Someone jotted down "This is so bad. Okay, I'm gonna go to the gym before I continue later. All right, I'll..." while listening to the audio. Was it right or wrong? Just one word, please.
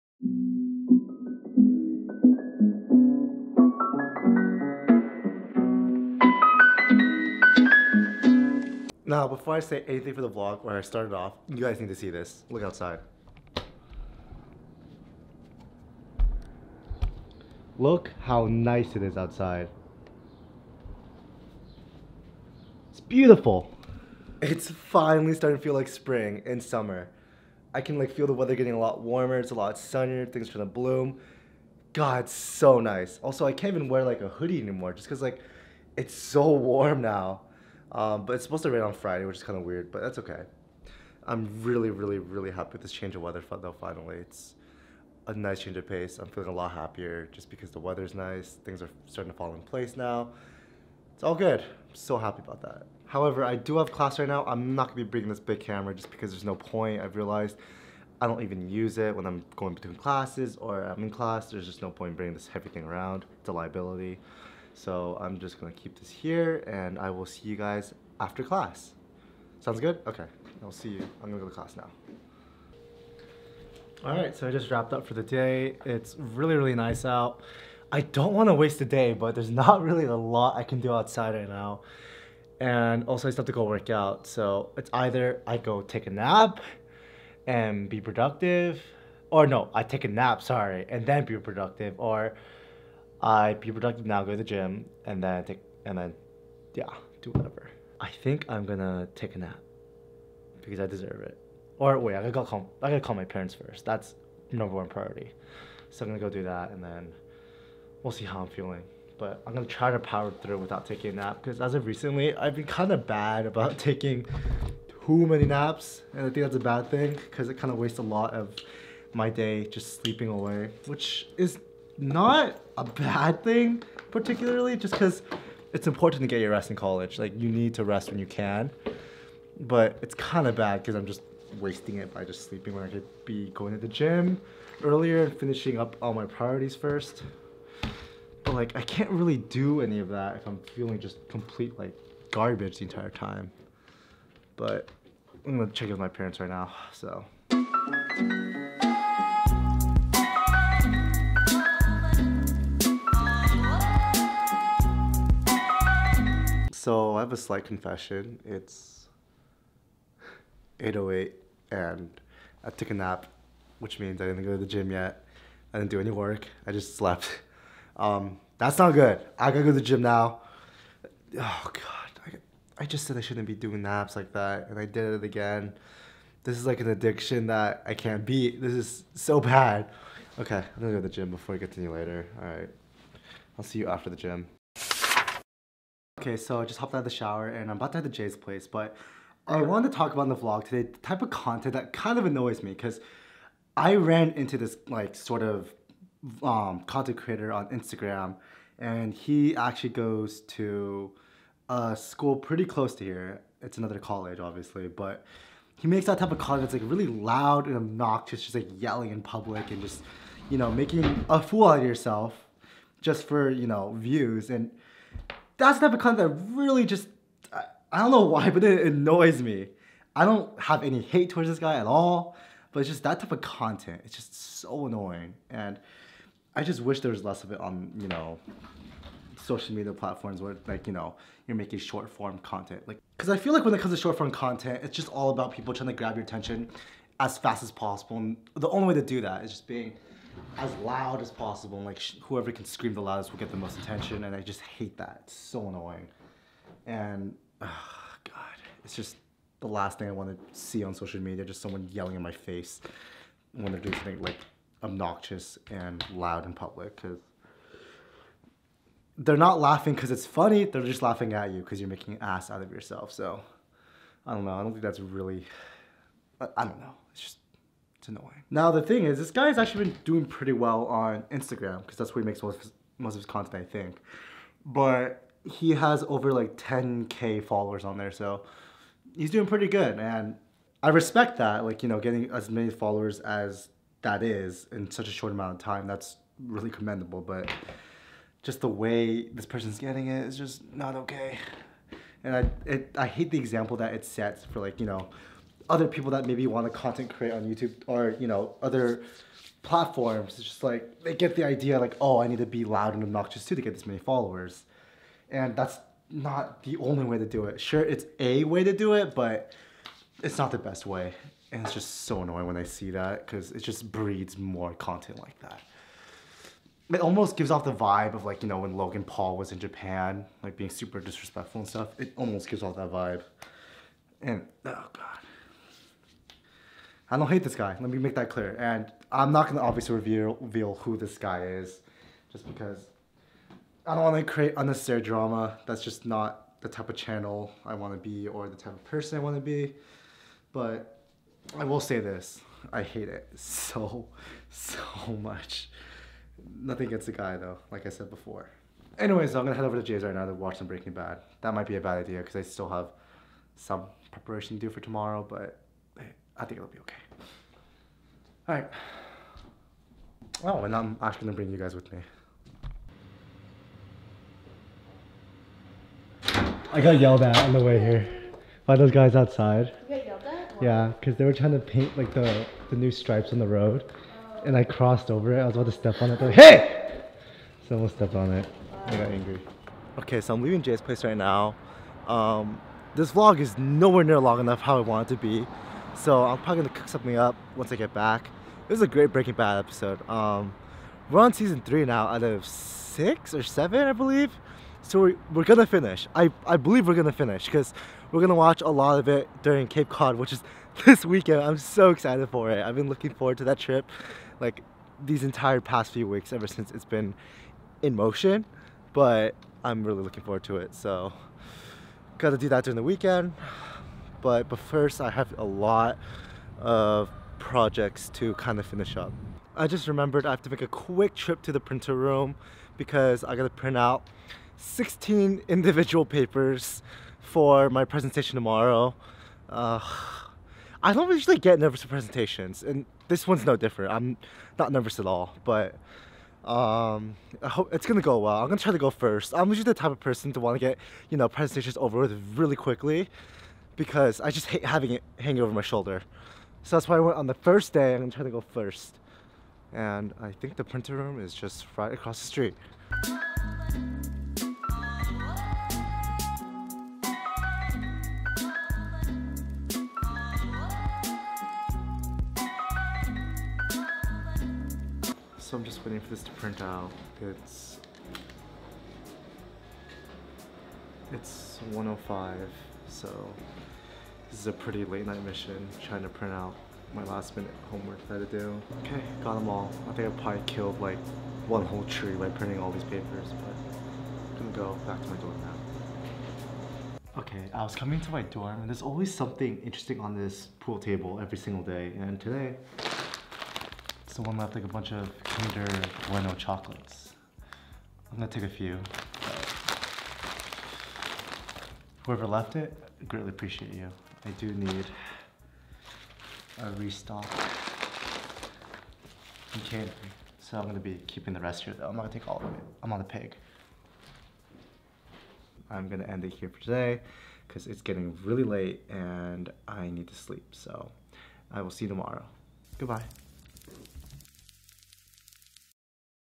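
right.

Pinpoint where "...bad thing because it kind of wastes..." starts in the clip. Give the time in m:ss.
1:56.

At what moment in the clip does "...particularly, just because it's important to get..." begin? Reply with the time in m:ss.
2:04.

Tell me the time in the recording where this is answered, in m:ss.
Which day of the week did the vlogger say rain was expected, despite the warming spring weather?
0:38.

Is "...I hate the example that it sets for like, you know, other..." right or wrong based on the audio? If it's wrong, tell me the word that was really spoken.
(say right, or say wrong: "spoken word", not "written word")
right.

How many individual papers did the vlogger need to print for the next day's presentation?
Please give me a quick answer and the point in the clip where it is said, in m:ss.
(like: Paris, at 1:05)
16, at 7:04.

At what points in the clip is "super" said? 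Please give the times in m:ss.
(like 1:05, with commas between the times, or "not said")
5:20.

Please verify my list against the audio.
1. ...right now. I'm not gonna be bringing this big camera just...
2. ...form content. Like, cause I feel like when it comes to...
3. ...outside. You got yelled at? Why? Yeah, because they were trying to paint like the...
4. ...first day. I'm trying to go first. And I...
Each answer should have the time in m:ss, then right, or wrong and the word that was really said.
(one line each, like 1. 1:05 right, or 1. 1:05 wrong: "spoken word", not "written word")
1. 0:54 right
2. 3:52 right
3. 6:09 right
4. 7:27 right.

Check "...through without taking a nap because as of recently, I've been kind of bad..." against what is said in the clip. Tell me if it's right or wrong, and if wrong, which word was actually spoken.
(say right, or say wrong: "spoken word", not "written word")
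right.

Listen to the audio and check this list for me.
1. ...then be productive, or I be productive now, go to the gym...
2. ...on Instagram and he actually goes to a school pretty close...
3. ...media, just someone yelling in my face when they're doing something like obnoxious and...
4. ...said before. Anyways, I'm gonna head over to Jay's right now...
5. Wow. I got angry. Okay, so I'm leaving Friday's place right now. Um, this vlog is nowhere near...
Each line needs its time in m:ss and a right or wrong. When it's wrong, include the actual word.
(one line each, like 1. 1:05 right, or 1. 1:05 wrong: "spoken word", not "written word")
1. 1:31 right
2. 3:17 right
3. 4:11 right
4. 5:47 right
5. 6:18 wrong: "Jay", not "Friday".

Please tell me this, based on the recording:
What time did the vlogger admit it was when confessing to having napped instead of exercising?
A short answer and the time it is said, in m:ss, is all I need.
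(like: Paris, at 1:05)
8:08, at 2:40.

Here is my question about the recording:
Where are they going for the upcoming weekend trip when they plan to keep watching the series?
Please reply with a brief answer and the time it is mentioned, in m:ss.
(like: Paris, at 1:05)
Cape Cod, at 6:39.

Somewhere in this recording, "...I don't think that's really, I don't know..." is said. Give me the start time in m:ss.
4:24.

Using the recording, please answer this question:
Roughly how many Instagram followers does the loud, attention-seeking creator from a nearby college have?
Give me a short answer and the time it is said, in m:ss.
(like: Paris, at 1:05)
10k, at 4:36.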